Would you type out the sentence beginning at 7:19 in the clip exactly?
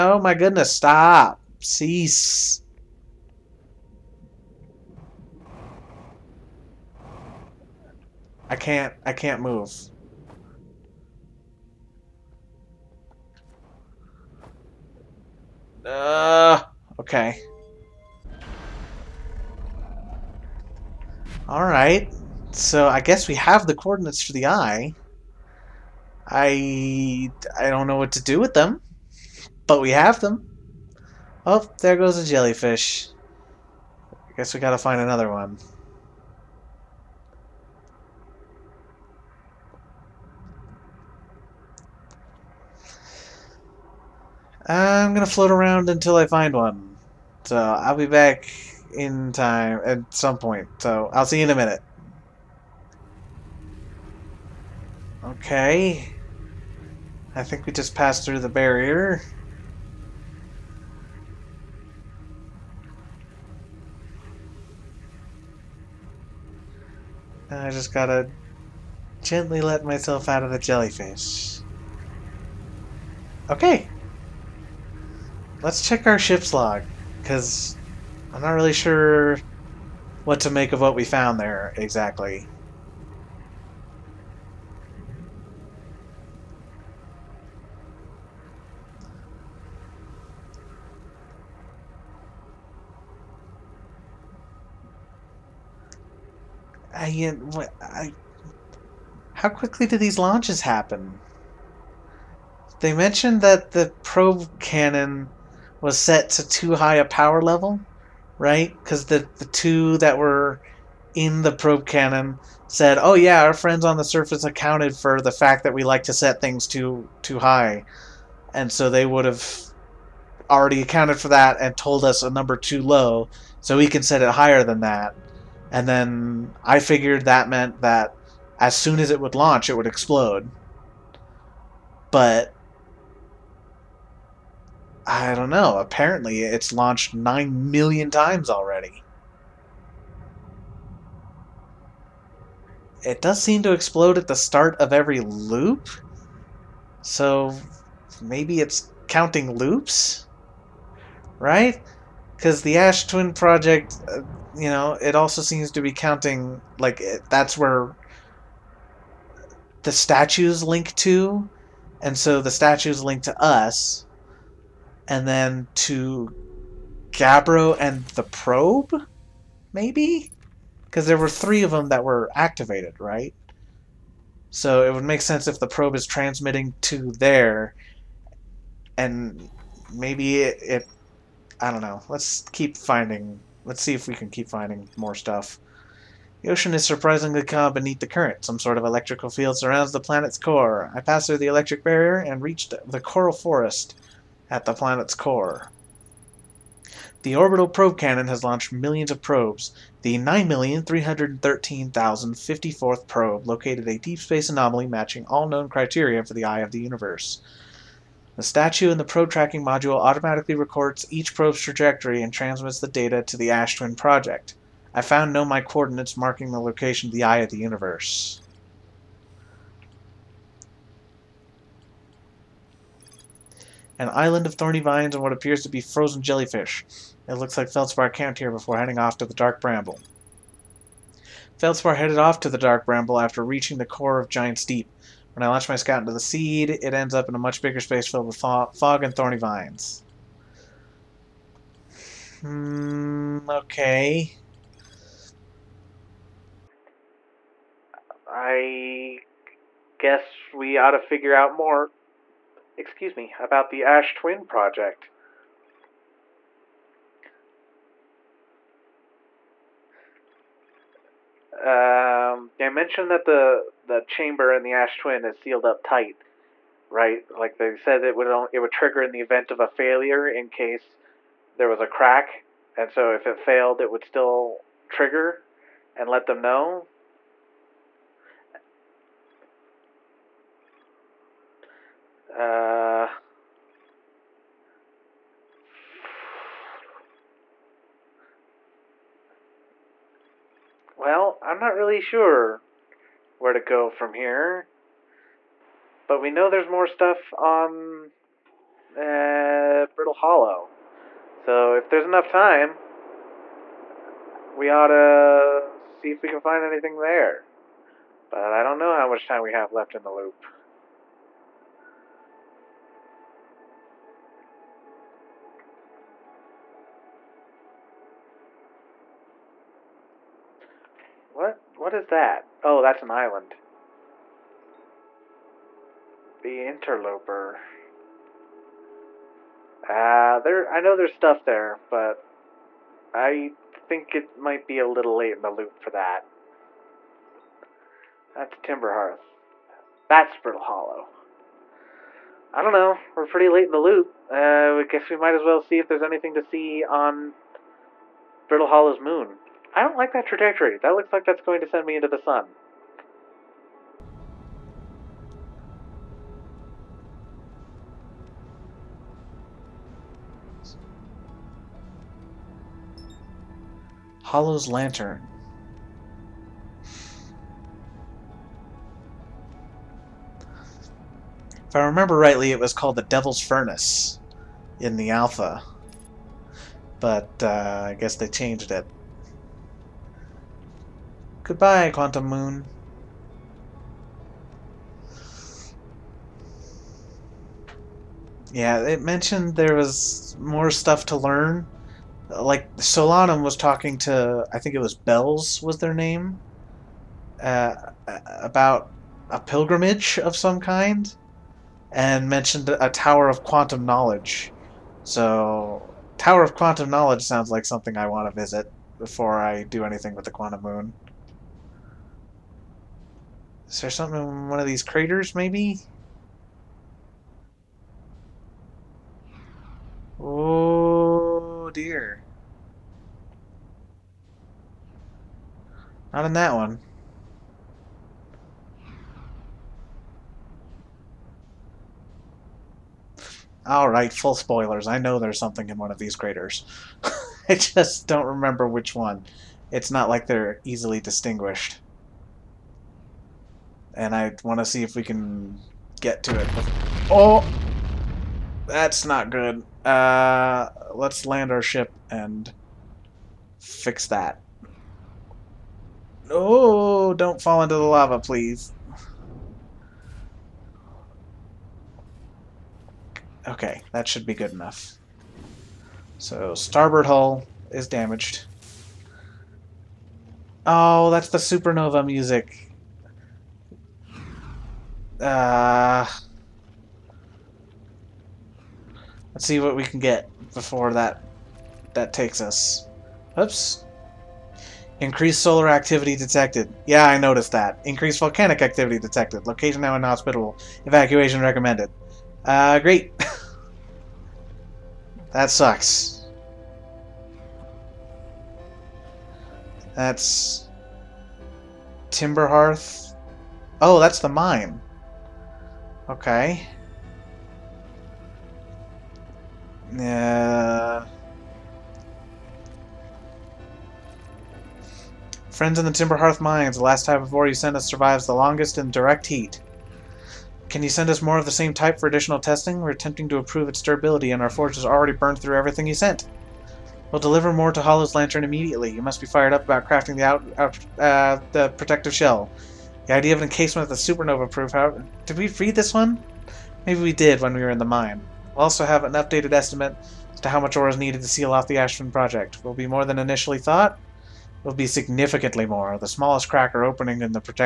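It's not like they're easily distinguished and I want to see if we can get to it.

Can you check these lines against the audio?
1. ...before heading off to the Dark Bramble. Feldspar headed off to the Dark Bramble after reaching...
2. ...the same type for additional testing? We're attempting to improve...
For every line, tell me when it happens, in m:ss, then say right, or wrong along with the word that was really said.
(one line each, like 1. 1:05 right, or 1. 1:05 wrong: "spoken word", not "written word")
1. 3:48 right
2. 8:41 right.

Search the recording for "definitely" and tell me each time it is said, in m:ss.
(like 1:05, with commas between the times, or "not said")
not said.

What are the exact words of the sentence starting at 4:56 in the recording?
But we know there's more stuff on uh, Brittle Hollow.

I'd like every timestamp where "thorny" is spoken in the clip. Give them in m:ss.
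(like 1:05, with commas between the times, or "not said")
3:44, 3:59.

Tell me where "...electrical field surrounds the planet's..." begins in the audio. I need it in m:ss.
3:08.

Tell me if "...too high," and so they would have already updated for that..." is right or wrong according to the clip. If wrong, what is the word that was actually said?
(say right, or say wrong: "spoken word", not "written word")
wrong: "accounted", not "updated".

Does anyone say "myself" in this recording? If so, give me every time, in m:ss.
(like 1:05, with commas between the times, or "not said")
1:09.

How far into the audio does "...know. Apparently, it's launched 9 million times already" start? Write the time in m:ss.
2:15.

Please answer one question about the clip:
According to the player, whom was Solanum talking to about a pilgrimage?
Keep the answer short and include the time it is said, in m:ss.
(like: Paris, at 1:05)
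Bells, at 6:34.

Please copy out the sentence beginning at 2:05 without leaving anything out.
And then I figured that meant that as soon as it would launch, it would explode.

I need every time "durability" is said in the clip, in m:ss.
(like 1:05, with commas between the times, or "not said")
8:43.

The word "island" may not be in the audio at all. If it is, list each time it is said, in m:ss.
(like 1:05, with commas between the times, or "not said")
3:44, 5:23.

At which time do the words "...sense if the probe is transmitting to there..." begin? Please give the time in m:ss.
2:55.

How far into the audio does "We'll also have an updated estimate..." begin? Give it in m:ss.
8:58.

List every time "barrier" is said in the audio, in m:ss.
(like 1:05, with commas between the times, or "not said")
0:58, 3:11.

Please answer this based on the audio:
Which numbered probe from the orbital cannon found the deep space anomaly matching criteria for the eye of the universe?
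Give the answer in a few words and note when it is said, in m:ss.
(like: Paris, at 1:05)
9,313,054th, at 3:20.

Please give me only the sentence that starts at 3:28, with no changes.
The statue in the probe tracking module automatically records each probe's trajectory and transmits the data to the Ash Twin project.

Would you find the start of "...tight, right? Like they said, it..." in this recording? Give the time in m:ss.
4:25.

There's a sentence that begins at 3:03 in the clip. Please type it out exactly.
Let's see if we can keep finding more stuff.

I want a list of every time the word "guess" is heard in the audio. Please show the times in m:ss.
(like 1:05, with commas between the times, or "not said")
0:23, 0:34, 4:09, 5:44, 6:17.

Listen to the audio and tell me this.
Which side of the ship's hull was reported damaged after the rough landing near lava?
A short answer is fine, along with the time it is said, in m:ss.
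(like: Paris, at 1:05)
starboard, at 7:46.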